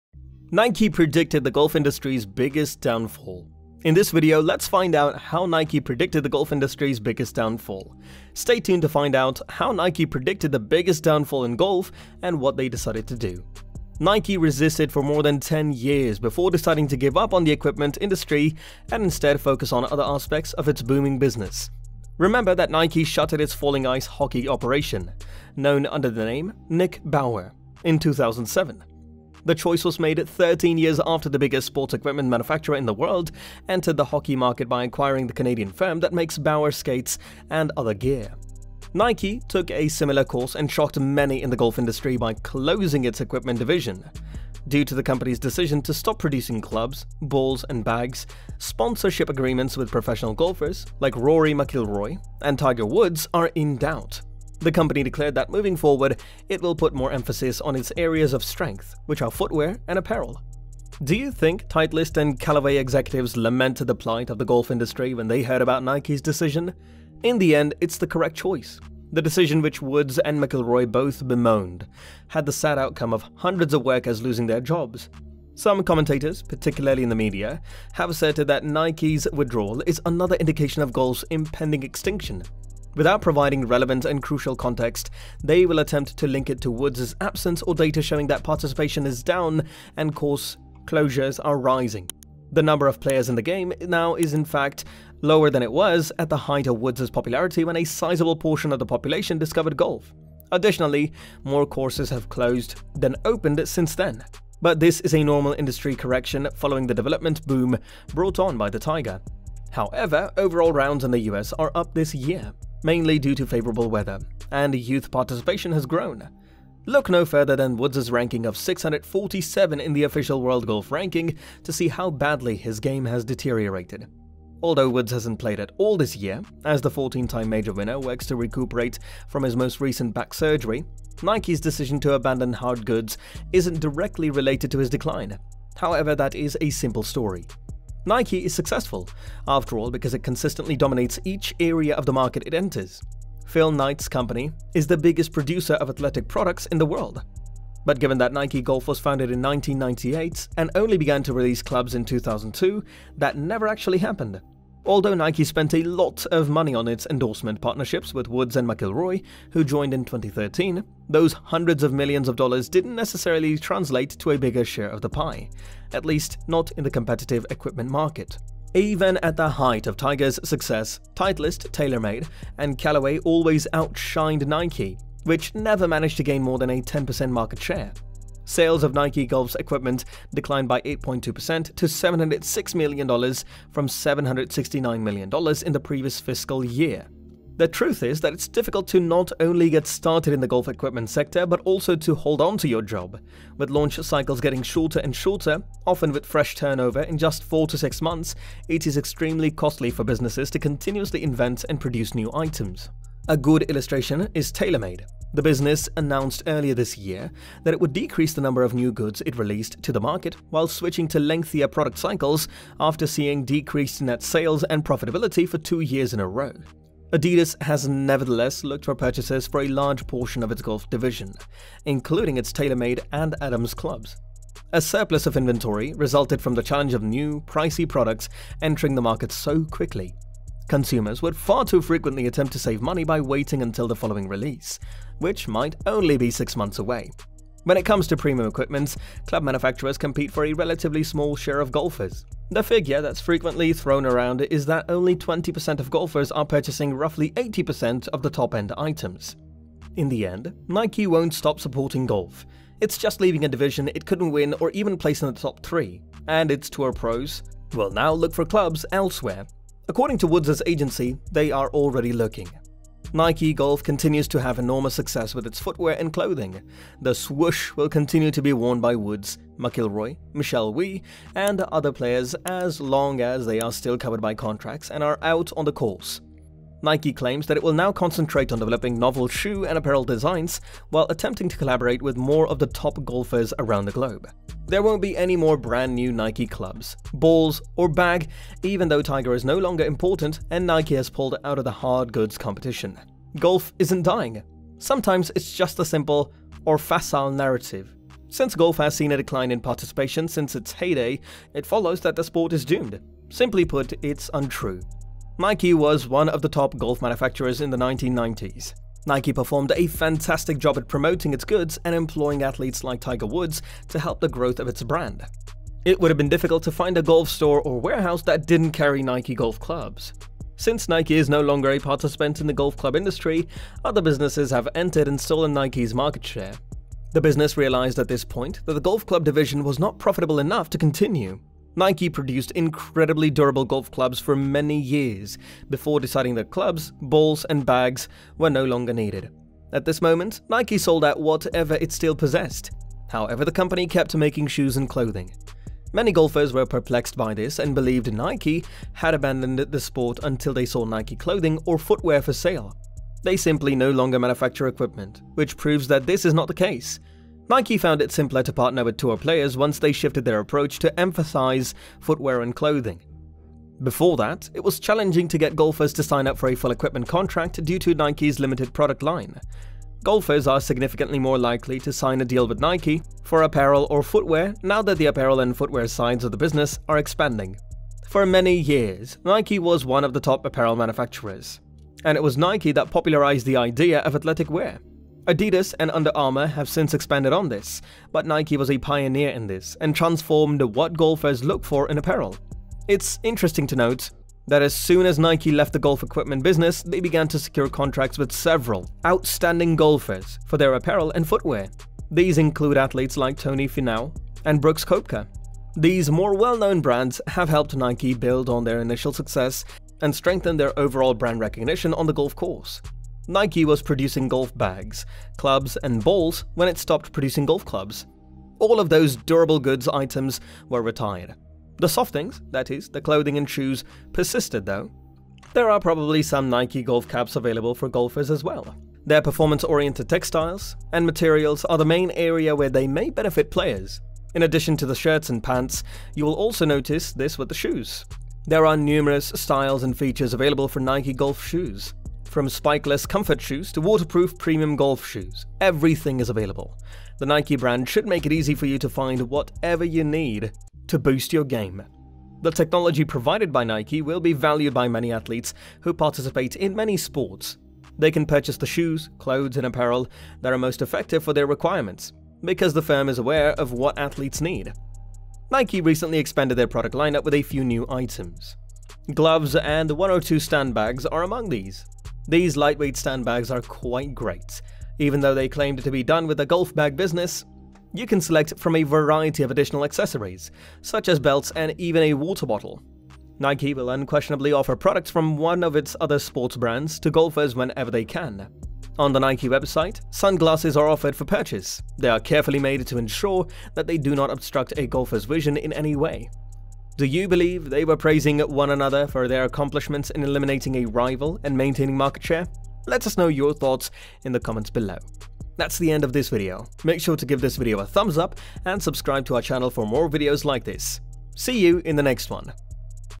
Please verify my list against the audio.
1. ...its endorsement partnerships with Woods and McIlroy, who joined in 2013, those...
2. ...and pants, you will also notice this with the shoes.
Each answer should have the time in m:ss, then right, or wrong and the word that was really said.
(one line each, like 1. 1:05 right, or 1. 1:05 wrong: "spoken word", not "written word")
1. 2:36 right
2. 7:15 right.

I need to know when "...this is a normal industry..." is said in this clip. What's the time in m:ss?
1:44.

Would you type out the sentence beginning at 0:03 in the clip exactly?
In this video, let's find out how Nike predicted the golf industry's biggest downfall.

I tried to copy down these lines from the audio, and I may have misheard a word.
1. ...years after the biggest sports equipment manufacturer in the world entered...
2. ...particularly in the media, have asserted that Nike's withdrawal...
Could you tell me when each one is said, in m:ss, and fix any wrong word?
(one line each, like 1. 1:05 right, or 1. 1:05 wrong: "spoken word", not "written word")
1. 0:30 right
2. 1:16 right.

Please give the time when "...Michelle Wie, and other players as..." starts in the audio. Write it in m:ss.
4:30.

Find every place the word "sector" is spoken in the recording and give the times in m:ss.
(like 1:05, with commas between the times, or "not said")
3:11.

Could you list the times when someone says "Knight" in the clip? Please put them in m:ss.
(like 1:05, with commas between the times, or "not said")
2:23.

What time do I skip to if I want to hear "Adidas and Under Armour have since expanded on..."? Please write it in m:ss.
6:25.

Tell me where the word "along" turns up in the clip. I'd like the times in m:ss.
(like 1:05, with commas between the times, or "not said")
not said.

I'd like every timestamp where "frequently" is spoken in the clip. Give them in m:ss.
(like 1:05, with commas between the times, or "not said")
3:51, 4:03.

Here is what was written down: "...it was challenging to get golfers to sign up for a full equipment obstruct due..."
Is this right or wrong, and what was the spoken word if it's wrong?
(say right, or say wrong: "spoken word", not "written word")
wrong: "contract", not "obstruct".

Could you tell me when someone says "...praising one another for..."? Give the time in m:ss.
8:17.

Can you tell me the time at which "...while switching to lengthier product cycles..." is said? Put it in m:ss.
3:30.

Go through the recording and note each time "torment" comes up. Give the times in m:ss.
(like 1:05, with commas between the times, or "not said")
not said.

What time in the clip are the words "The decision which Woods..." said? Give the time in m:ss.
1:09.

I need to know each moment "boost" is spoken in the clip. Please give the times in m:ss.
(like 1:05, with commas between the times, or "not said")
7:30.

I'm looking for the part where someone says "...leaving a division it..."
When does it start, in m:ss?
4:13.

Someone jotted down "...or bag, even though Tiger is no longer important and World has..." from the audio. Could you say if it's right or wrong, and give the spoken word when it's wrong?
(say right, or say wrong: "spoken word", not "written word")
wrong: "Nike", not "World".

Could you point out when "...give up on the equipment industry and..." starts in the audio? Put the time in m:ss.
0:16.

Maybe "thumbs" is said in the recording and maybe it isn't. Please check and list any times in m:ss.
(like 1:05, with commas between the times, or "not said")
8:27.